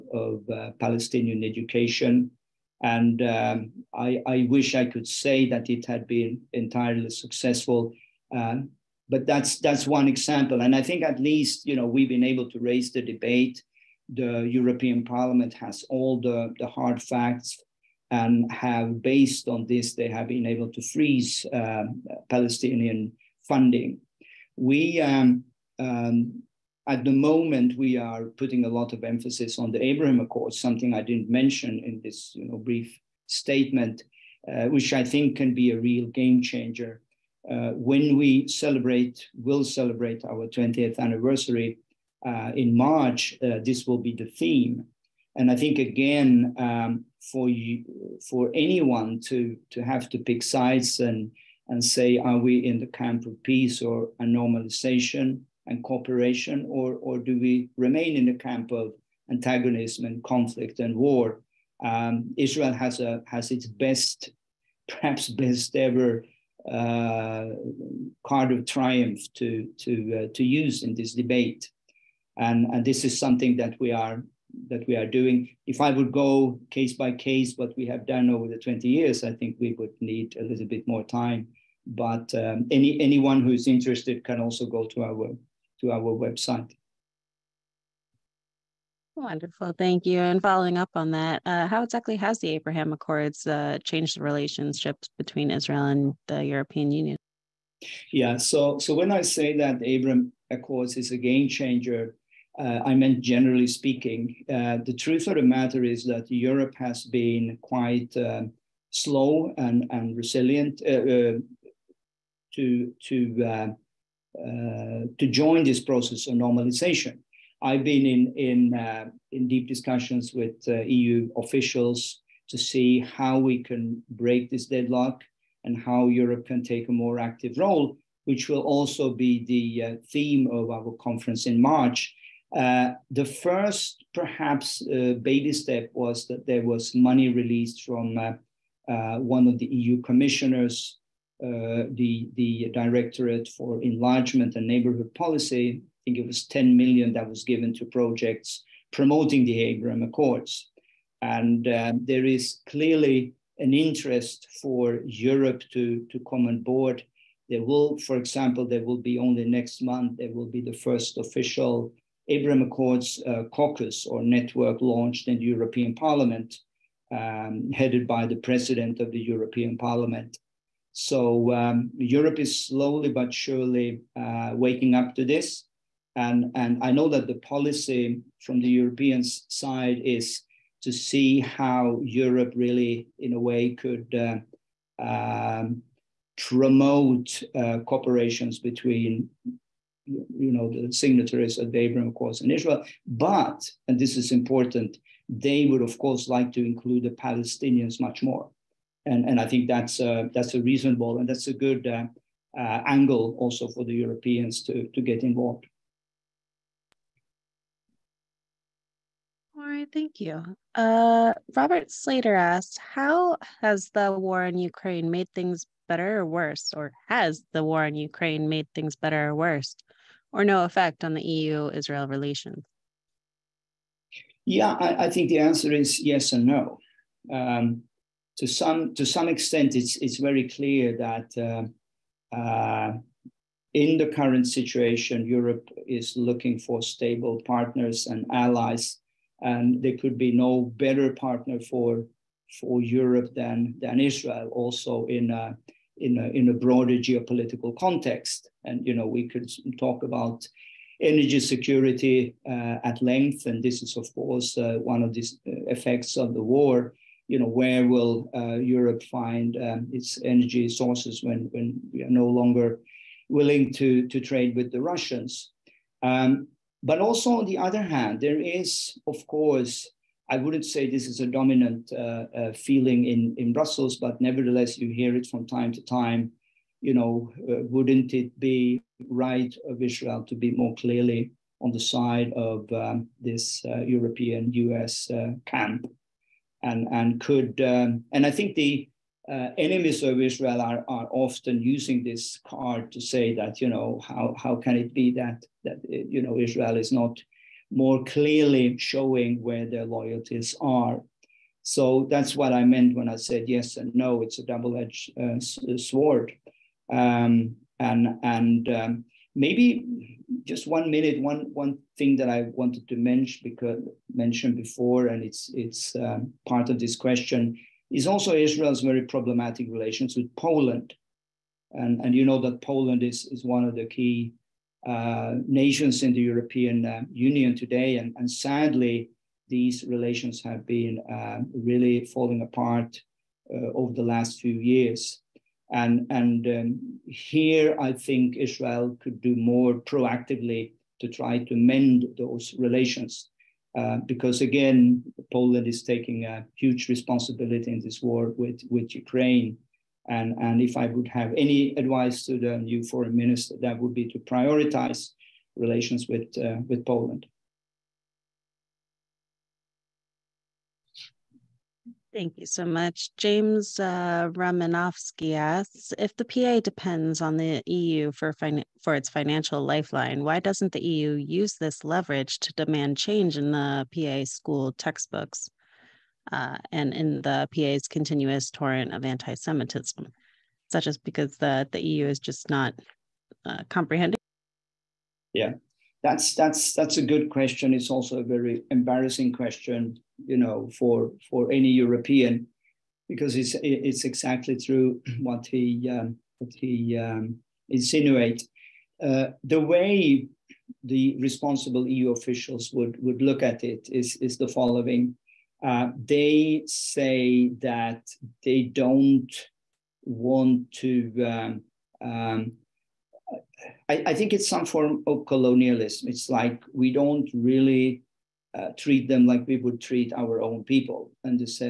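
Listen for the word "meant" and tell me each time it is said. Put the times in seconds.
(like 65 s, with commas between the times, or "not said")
102 s, 302 s.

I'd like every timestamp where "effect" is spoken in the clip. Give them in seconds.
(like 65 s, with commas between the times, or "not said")
220 s, 255 s.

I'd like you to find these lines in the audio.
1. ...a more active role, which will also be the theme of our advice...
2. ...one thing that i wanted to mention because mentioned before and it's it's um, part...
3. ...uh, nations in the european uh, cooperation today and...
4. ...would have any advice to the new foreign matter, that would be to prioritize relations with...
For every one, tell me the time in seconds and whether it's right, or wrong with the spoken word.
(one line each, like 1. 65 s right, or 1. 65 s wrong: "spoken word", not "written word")
1. 126 s wrong: "conference", not "advice"
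2. 311 s right
3. 324 s wrong: "union", not "cooperation"
4. 350 s wrong: "minister", not "matter".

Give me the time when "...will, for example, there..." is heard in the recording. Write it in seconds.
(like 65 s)
157 s.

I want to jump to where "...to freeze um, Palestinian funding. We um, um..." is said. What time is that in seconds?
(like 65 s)
20 s.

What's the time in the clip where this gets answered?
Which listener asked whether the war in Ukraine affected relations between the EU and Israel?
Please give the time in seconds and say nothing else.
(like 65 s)
211 s.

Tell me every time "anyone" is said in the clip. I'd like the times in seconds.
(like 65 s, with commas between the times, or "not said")
48 s, 83 s.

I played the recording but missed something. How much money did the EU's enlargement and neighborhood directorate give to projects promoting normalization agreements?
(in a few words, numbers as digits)
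10 million.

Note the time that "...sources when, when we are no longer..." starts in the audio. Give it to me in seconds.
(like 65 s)
260 s.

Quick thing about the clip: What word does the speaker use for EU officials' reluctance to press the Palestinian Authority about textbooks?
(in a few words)
colonialism.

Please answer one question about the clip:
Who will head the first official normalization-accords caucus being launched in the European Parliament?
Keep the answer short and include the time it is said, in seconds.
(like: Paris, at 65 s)
President of the European Parliament, at 168 s.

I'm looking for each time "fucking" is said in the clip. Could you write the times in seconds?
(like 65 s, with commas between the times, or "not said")
not said.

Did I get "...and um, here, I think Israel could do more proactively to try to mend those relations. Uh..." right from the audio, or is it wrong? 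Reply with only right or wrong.
right.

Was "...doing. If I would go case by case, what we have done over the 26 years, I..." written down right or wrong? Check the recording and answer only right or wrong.
wrong.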